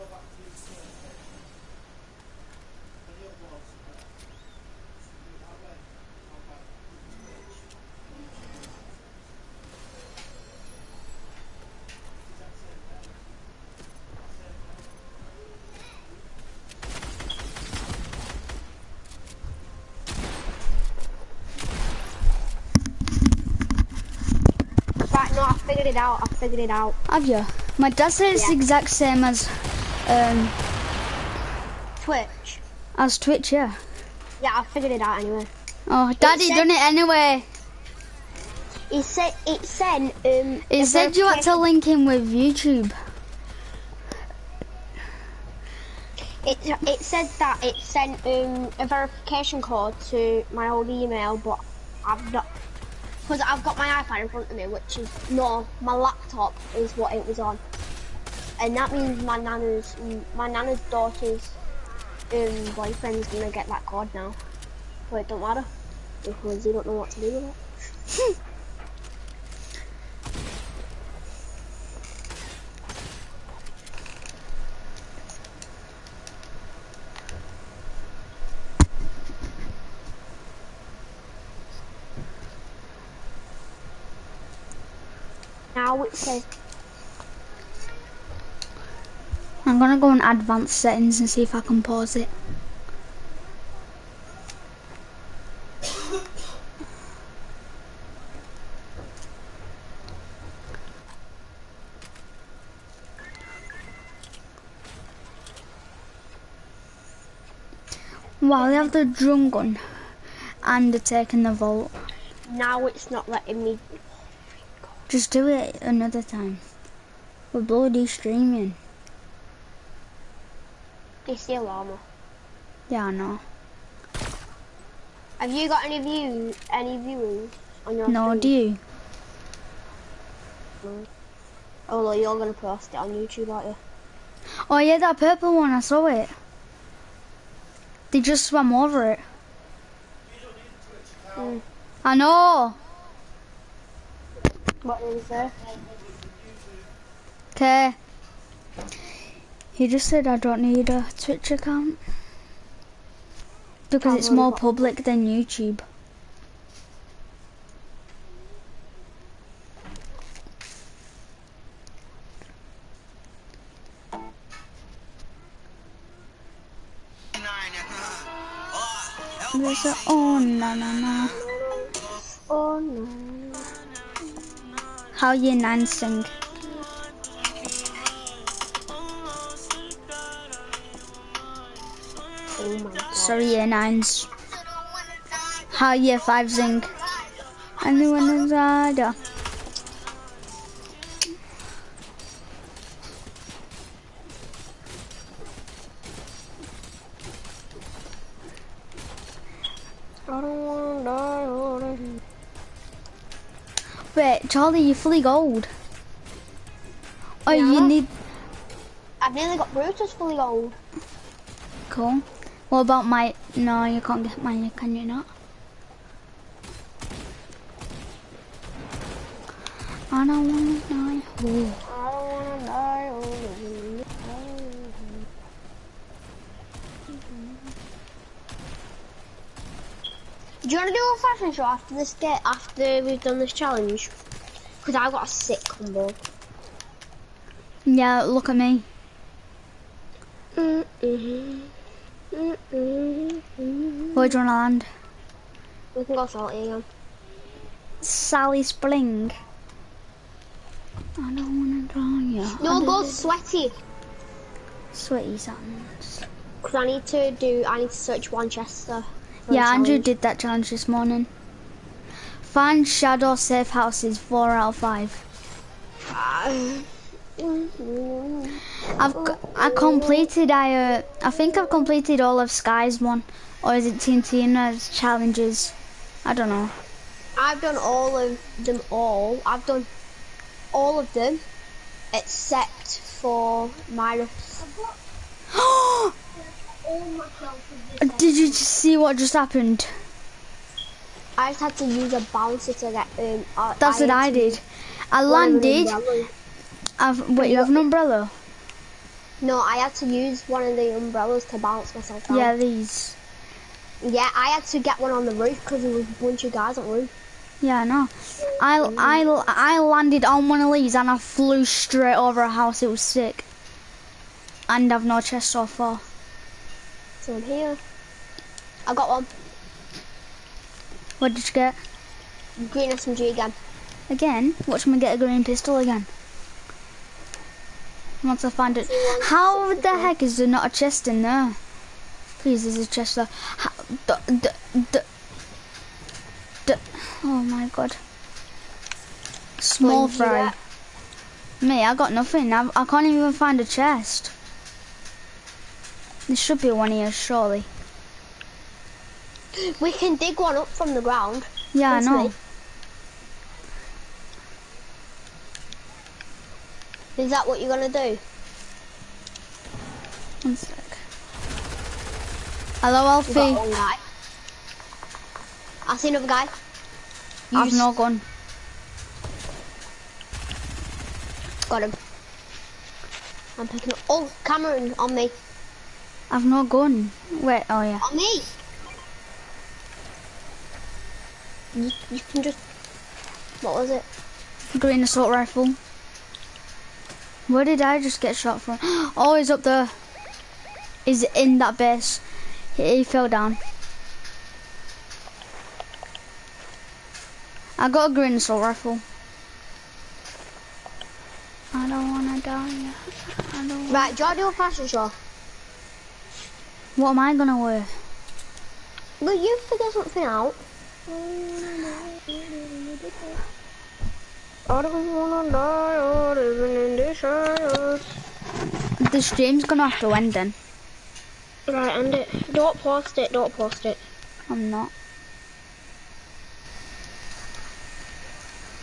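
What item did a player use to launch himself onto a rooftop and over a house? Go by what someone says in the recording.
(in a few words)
bouncer.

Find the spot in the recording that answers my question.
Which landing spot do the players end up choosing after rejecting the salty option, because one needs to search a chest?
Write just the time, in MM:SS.
04:15.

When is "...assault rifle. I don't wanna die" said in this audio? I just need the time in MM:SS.
06:38.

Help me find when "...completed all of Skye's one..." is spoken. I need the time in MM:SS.
04:31.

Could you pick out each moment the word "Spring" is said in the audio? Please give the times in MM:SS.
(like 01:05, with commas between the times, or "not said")
04:08.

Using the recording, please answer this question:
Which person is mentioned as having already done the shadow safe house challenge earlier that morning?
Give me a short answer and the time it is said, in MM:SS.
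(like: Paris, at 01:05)
Andrew, at 04:19.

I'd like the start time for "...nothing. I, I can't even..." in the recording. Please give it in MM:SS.
05:42.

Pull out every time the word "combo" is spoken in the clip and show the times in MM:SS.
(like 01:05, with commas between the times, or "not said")
03:55.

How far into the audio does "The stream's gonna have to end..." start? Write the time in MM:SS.
06:59.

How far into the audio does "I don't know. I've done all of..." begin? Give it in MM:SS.
04:36.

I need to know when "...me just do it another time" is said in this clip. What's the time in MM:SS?
01:53.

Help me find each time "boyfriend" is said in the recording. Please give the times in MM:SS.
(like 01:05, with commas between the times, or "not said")
01:02.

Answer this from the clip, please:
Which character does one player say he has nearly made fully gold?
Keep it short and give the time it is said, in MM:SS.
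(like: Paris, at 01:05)
Brutus, at 03:29.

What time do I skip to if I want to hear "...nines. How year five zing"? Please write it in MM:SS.
03:03.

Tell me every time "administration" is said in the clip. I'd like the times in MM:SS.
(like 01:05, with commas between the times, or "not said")
not said.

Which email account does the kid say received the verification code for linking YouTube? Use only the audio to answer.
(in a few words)
old email.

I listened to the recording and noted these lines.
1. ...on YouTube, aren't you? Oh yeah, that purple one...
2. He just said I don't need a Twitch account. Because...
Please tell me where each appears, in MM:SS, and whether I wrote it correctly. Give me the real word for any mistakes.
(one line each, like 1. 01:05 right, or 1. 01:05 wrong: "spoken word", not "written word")
1. 02:12 right
2. 02:29 right.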